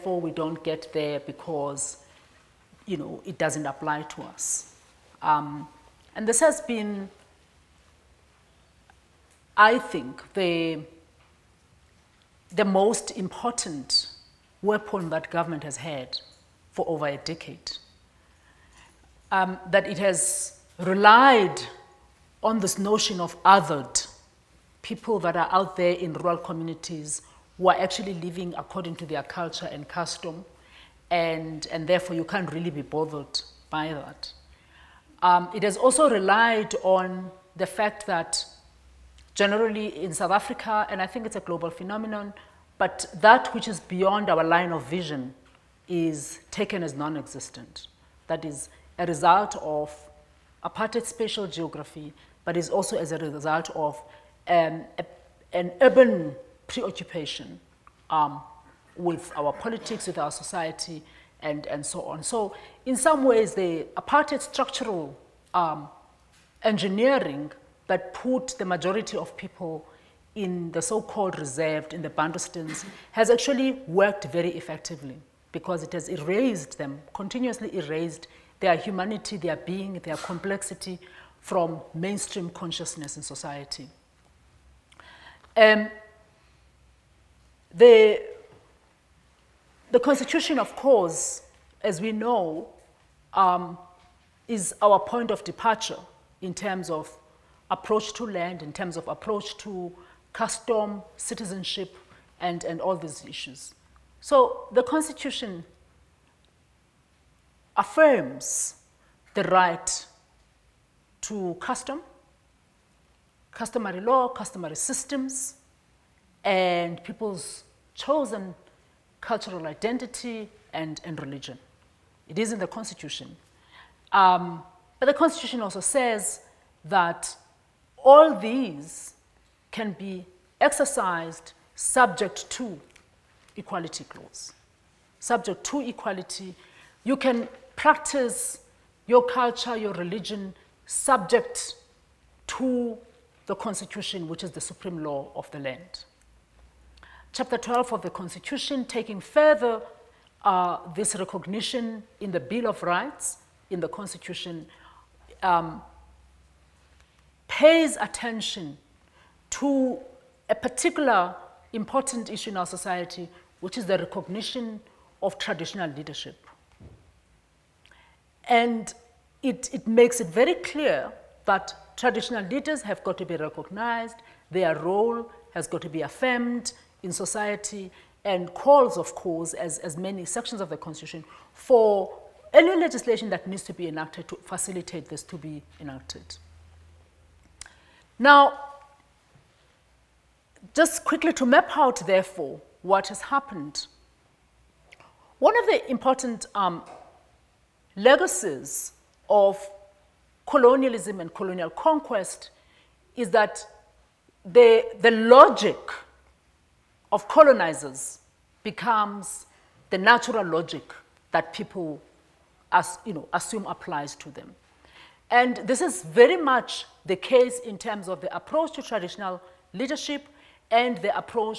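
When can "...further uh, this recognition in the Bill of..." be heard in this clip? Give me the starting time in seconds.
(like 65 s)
149 s.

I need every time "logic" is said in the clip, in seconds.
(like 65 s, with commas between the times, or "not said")
205 s, 210 s.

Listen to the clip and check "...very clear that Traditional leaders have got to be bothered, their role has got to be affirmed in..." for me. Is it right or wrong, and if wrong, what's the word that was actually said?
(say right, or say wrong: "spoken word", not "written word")
wrong: "recognized", not "bothered".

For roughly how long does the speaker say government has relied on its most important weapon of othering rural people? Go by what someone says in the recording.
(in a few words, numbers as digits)
over a decade.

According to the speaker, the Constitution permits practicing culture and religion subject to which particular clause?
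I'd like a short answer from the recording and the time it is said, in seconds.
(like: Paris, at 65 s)
equality clause, at 133 s.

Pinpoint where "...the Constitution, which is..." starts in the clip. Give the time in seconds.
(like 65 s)
143 s.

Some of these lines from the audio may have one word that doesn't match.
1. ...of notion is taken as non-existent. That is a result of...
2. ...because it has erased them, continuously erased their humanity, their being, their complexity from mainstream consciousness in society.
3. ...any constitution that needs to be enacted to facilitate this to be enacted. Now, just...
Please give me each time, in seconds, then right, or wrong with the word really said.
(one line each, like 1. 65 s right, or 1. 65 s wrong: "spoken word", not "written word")
1. 44 s wrong: "vision", not "notion"
2. 75 s right
3. 182 s wrong: "legislation", not "constitution".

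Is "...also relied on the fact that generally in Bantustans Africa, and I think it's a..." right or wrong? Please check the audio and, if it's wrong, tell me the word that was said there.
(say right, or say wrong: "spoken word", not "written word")
wrong: "South", not "Bantustans".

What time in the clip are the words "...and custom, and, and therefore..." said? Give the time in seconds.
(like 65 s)
29 s.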